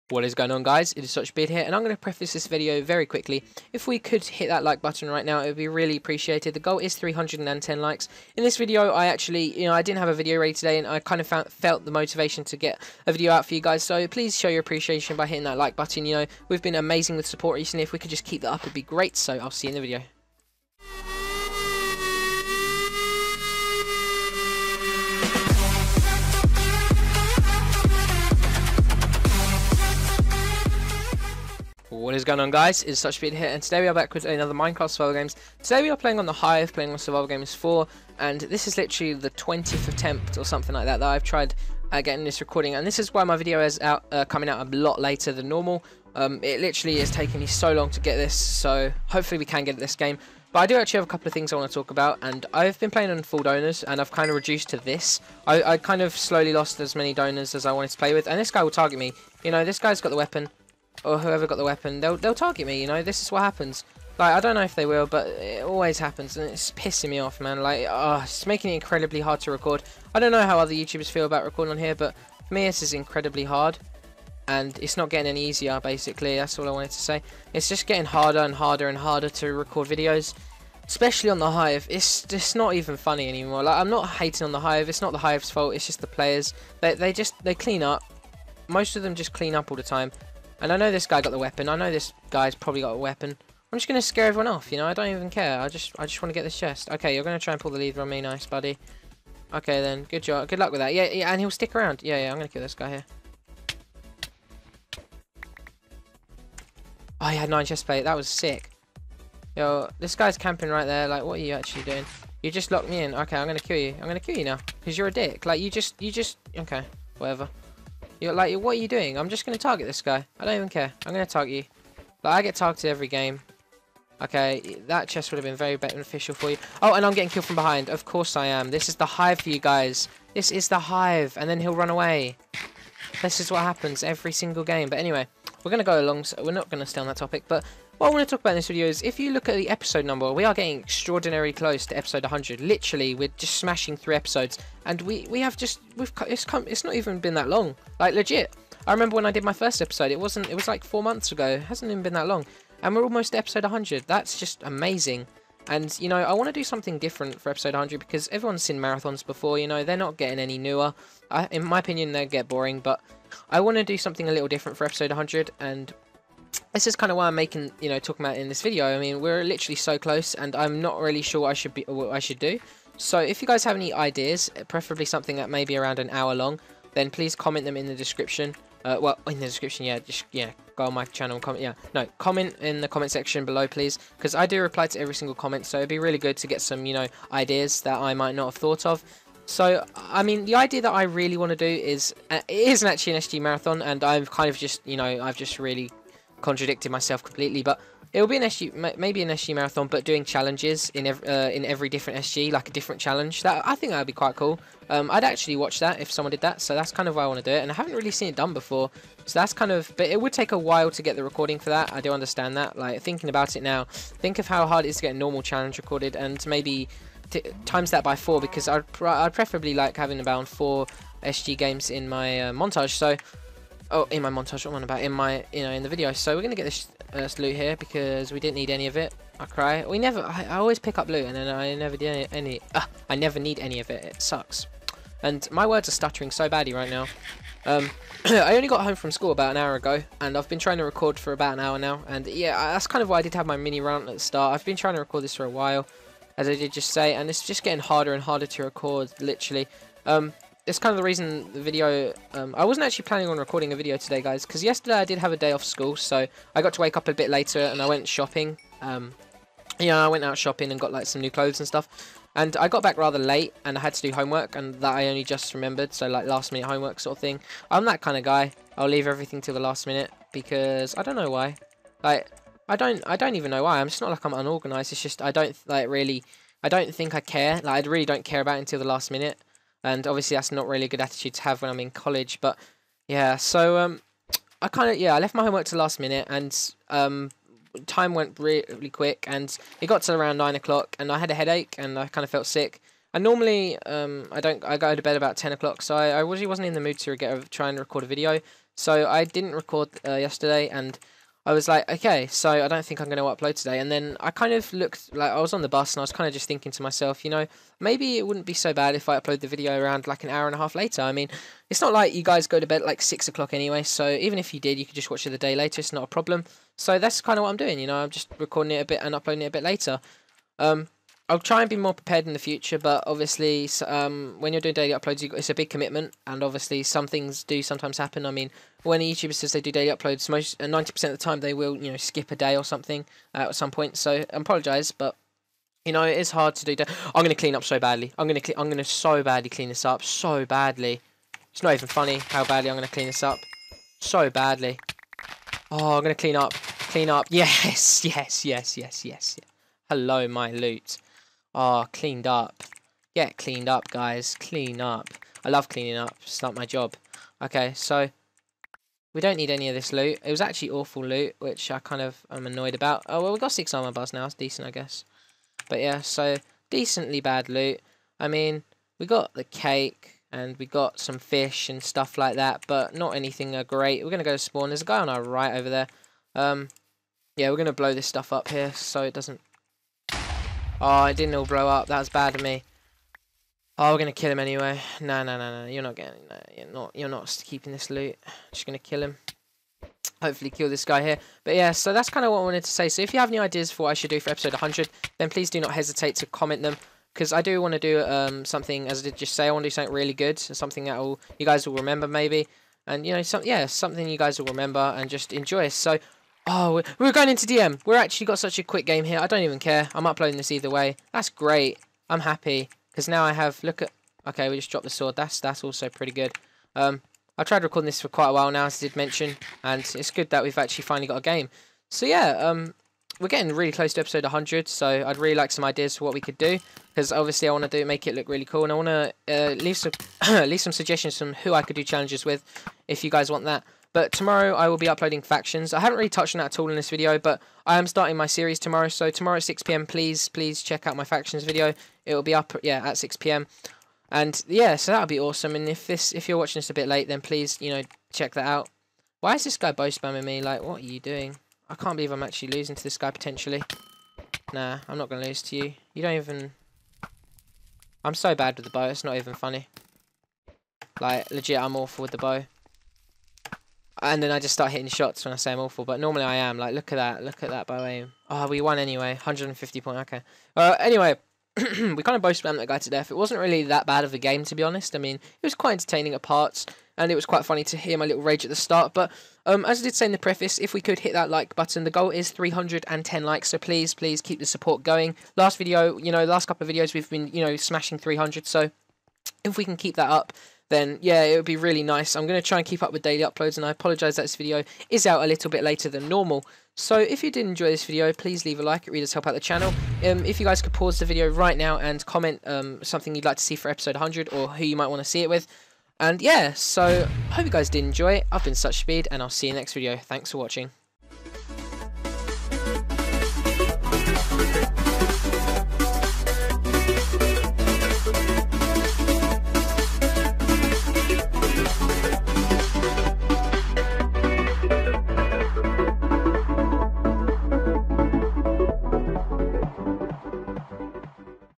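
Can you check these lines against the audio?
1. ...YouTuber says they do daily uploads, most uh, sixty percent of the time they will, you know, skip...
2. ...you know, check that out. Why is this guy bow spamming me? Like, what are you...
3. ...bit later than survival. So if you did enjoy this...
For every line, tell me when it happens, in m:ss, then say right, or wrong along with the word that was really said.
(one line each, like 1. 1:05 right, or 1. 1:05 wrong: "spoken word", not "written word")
1. 5:29 wrong: "ninety", not "sixty"
2. 7:27 right
3. 8:15 wrong: "normal", not "survival".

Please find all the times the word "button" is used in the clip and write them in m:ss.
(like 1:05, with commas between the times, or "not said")
0:04, 0:15, 8:01.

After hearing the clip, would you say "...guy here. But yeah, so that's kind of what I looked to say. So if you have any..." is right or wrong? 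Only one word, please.
wrong.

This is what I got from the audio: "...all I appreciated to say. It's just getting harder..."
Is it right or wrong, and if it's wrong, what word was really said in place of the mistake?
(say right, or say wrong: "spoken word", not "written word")
wrong: "wanted", not "appreciated".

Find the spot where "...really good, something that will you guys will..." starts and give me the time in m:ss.
6:39.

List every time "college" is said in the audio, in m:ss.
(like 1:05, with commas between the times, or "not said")
4:41.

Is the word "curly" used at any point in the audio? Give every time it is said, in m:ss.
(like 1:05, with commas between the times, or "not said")
not said.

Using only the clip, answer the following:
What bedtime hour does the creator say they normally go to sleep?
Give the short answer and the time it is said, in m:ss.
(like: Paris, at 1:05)
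10 o'clock, at 4:55.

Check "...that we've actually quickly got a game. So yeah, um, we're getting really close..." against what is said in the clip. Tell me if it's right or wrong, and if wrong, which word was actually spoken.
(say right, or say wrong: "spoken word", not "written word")
wrong: "finally", not "quickly".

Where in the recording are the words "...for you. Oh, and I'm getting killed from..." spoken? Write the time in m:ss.
2:06.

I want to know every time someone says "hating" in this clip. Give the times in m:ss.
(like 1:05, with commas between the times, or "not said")
1:24.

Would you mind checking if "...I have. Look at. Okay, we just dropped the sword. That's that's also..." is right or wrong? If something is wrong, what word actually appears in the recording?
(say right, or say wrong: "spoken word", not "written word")
right.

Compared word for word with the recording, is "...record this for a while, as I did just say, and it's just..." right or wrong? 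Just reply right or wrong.
right.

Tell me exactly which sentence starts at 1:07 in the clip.
Like, oh, it's making it incredibly hard to record.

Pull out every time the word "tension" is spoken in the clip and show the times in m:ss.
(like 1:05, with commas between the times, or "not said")
not said.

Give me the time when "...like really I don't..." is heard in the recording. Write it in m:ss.
4:35.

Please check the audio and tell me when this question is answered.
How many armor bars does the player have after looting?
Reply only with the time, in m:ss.
6:03.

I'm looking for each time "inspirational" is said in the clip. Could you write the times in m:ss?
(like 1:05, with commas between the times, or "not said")
not said.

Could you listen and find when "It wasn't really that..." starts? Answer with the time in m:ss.
7:53.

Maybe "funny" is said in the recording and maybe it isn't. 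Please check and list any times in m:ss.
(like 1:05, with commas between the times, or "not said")
1:22, 5:41, 7:39, 7:57.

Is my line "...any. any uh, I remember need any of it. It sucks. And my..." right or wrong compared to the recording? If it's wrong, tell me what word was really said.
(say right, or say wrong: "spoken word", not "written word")
wrong: "never", not "remember".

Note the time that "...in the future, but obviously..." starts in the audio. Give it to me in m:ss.
5:22.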